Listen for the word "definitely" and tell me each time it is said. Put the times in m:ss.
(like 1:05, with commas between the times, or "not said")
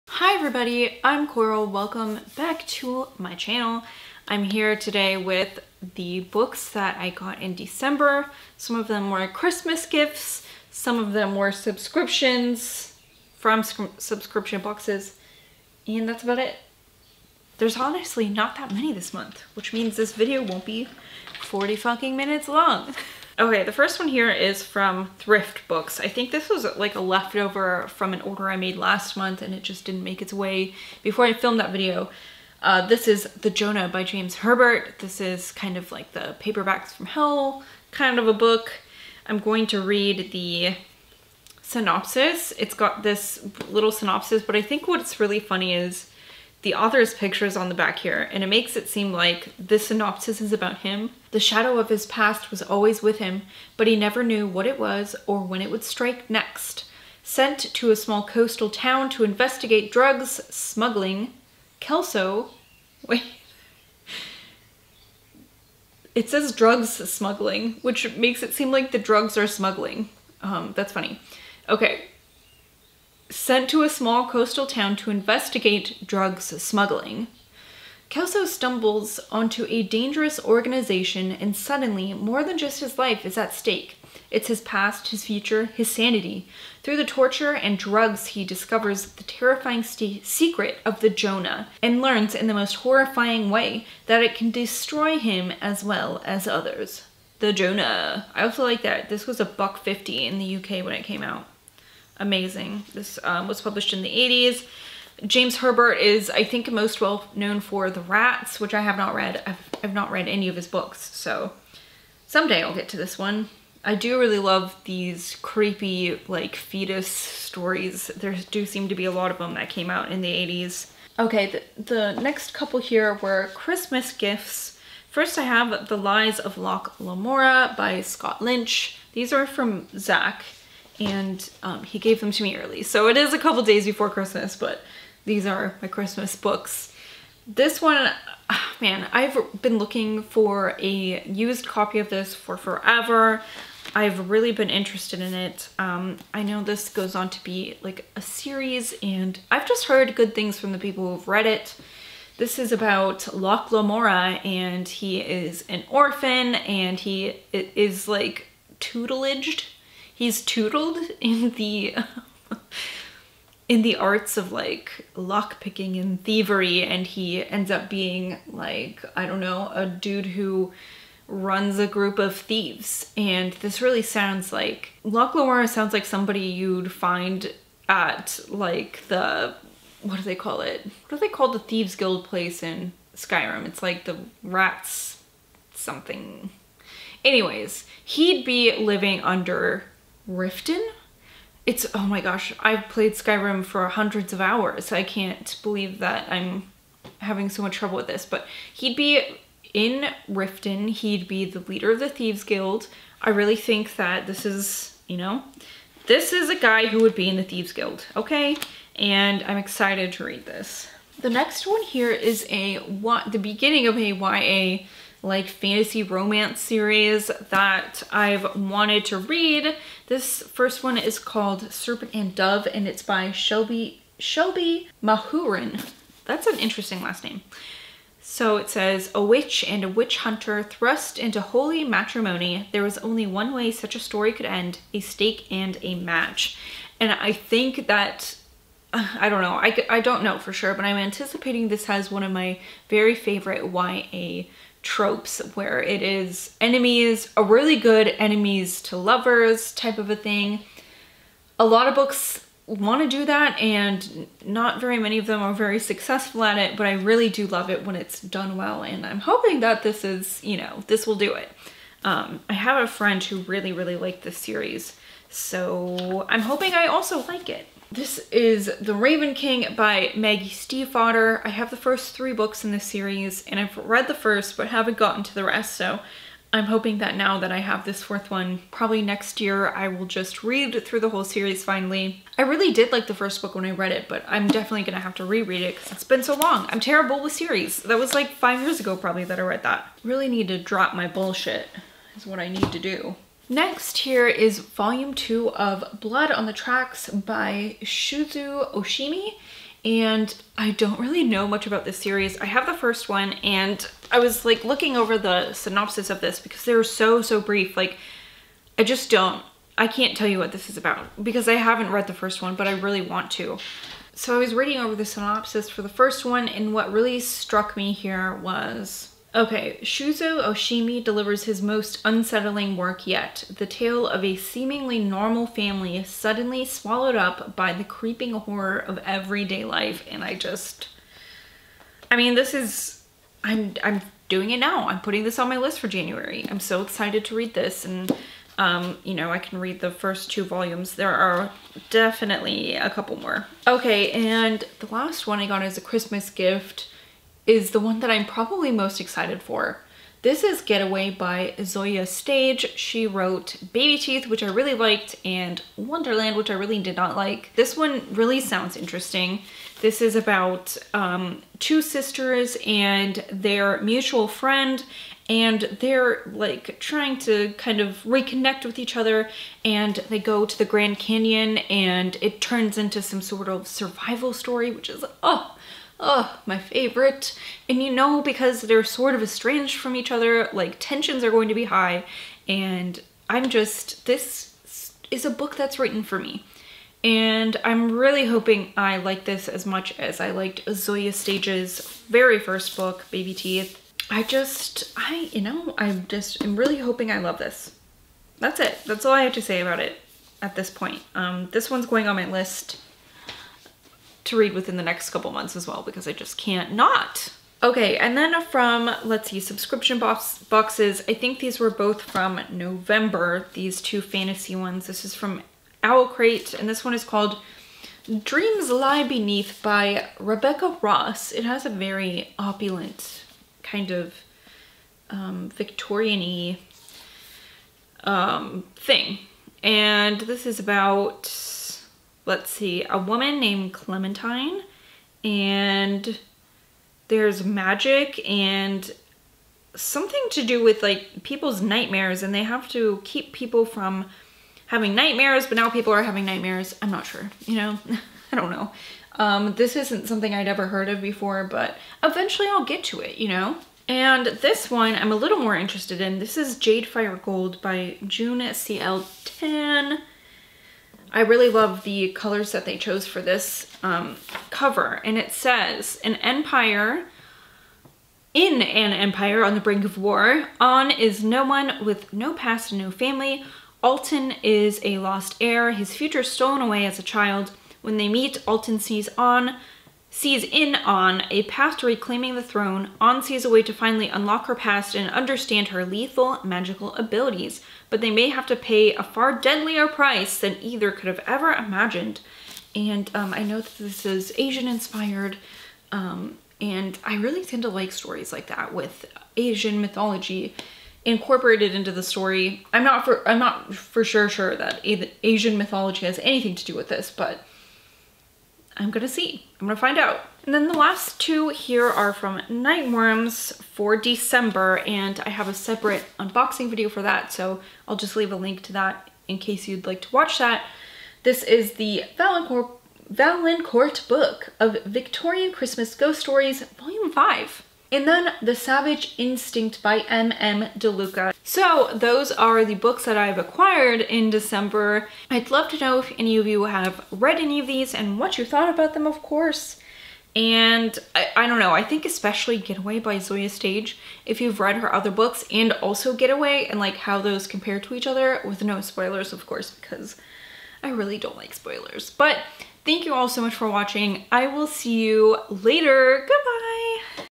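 4:44, 5:41.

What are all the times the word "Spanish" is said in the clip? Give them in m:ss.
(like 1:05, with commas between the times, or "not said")
not said.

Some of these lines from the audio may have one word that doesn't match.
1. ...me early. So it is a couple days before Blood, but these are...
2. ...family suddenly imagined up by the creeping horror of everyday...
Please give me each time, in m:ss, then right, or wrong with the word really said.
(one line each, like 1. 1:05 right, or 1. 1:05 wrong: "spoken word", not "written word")
1. 2:12 wrong: "Christmas", not "Blood"
2. 5:25 wrong: "swallowed", not "imagined".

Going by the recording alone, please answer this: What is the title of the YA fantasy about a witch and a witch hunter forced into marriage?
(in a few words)
Serpent and Dove.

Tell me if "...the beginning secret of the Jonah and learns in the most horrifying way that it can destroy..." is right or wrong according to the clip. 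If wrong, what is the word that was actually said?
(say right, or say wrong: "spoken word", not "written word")
wrong: "terrifying", not "beginning".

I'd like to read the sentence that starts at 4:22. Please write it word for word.
Um, I have a friend who really, really liked this series, so I'm hoping I also like it.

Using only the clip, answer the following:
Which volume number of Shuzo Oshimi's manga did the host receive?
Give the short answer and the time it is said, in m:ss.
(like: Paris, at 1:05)
2, at 4:54.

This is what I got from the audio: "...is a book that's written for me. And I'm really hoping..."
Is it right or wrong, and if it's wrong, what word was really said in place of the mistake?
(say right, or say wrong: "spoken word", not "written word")
right.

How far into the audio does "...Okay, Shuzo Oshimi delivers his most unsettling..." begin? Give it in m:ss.
5:19.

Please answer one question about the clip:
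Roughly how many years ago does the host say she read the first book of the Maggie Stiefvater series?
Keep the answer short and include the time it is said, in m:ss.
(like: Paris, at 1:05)
5, at 4:48.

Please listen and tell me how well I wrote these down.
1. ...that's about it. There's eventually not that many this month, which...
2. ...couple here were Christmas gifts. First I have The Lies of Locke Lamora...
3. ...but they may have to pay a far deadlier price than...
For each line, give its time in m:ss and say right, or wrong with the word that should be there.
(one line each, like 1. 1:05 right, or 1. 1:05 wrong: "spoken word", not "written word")
1. 0:16 wrong: "honestly", not "eventually"
2. 2:02 right
3. 8:07 right.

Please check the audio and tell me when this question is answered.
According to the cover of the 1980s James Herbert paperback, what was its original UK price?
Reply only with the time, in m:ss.
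1:39.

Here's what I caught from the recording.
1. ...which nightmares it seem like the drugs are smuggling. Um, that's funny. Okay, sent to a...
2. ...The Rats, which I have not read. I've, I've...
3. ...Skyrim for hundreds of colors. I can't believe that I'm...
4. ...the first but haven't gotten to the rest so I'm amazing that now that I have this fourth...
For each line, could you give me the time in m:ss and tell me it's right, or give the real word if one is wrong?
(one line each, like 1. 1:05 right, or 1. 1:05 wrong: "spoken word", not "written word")
1. 1:07 wrong: "makes", not "nightmares"
2. 1:47 right
3. 3:13 wrong: "hours", not "colors"
4. 4:34 wrong: "hoping", not "amazing".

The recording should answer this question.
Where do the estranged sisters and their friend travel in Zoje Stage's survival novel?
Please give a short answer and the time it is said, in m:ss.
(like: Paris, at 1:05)
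the Grand Canyon, at 6:10.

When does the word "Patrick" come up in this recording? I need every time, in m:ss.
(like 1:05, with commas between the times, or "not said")
not said.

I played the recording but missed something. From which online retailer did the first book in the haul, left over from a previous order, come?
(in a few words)
Thrift Books.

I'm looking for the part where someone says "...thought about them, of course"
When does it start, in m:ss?
8:58.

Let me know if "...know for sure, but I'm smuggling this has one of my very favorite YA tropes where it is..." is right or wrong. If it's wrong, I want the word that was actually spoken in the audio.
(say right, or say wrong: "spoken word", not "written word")
wrong: "anticipating", not "smuggling".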